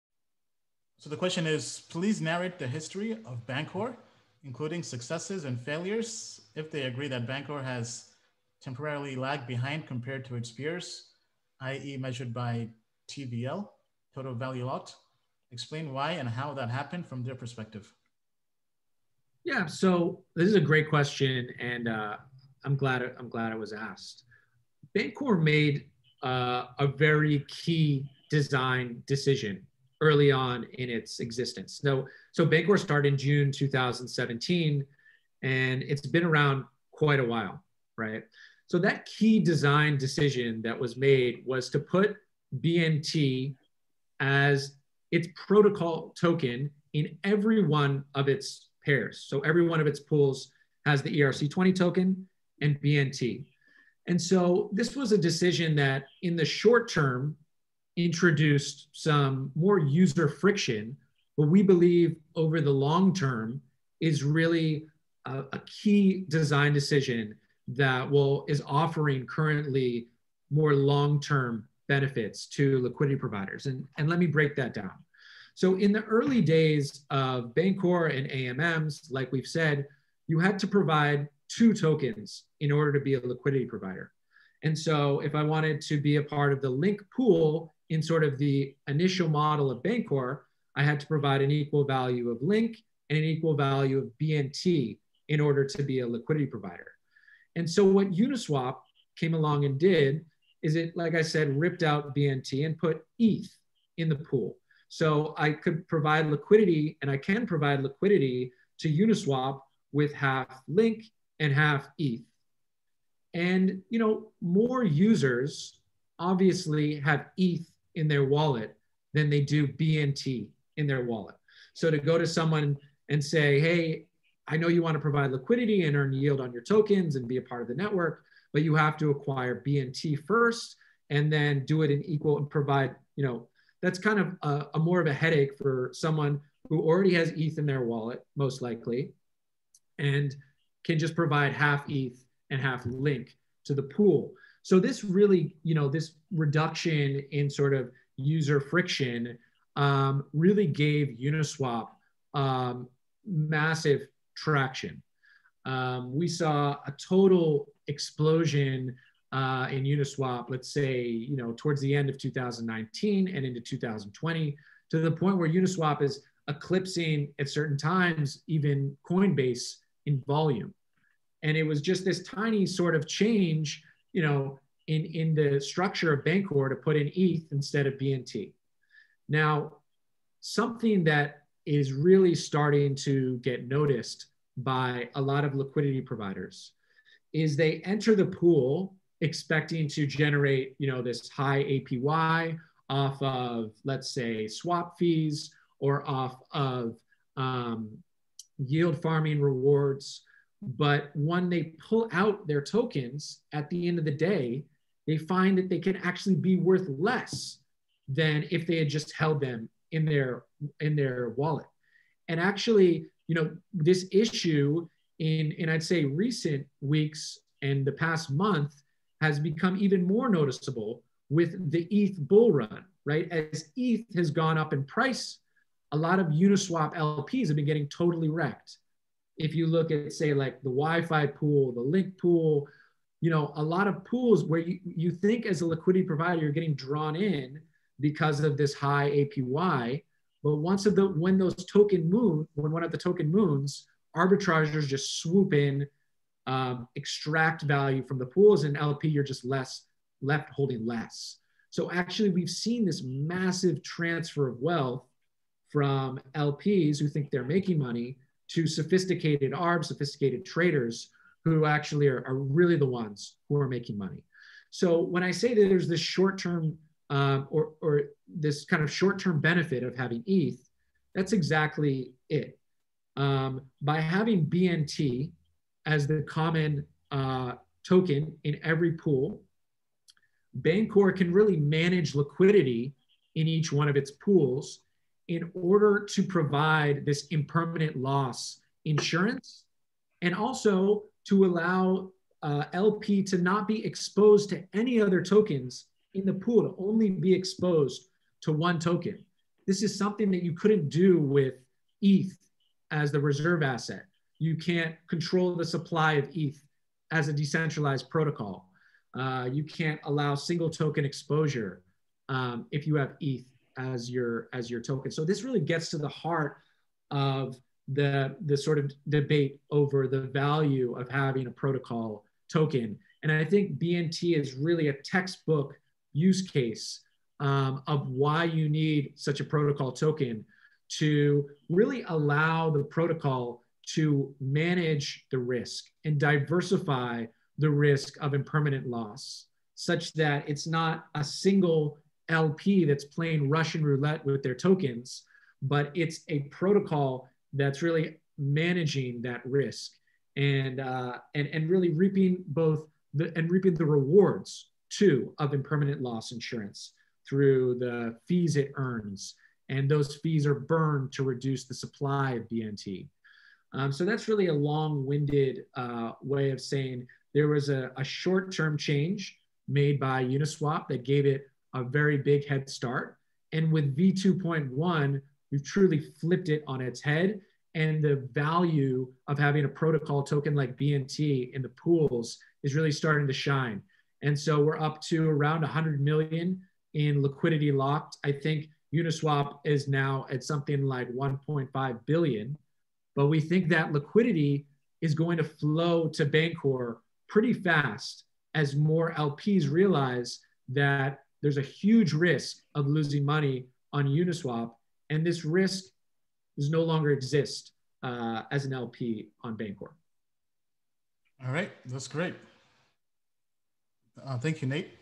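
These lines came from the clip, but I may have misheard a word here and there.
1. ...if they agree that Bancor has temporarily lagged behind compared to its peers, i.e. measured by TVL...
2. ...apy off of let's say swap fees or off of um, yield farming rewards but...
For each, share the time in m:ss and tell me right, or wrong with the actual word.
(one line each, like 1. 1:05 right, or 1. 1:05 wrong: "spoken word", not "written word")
1. 0:06 right
2. 3:11 right.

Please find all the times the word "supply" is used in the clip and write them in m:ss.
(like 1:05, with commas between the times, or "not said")
5:05, 6:01.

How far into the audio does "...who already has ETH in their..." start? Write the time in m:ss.
2:16.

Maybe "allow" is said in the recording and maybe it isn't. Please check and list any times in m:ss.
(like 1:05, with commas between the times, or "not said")
4:51, 5:10, 5:32.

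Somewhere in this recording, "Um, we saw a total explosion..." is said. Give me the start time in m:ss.
2:35.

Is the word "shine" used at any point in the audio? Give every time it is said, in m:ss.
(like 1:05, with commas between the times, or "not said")
6:23.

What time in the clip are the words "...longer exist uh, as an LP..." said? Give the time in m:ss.
6:46.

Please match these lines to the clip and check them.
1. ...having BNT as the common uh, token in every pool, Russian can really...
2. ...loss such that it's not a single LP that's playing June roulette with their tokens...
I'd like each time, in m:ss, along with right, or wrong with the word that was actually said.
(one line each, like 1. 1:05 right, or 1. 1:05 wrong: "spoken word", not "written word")
1. 4:34 wrong: "Bancor", not "Russian"
2. 5:38 wrong: "Russian", not "June".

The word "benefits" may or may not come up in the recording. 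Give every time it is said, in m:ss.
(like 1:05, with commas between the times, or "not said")
1:11, 4:29.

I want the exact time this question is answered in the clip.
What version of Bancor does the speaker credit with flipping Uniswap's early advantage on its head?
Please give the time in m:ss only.
6:13.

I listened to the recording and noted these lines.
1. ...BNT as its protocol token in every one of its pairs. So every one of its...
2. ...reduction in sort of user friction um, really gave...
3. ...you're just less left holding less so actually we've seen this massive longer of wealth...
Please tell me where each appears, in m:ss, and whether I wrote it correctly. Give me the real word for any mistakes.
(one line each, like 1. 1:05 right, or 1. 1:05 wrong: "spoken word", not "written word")
1. 0:42 right
2. 2:26 right
3. 4:09 wrong: "transfer", not "longer".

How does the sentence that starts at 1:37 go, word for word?
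And so what Uniswap came along and did is it, like I said, ripped out BNT and put ETH in the pool.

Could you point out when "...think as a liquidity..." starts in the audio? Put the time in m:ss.
3:55.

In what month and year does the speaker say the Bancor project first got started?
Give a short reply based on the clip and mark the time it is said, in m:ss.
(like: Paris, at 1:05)
June 2017, at 0:33.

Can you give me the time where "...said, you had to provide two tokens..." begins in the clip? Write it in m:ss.
1:19.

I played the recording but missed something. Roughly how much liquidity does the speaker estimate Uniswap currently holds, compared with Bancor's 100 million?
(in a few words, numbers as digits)
1.5 billion.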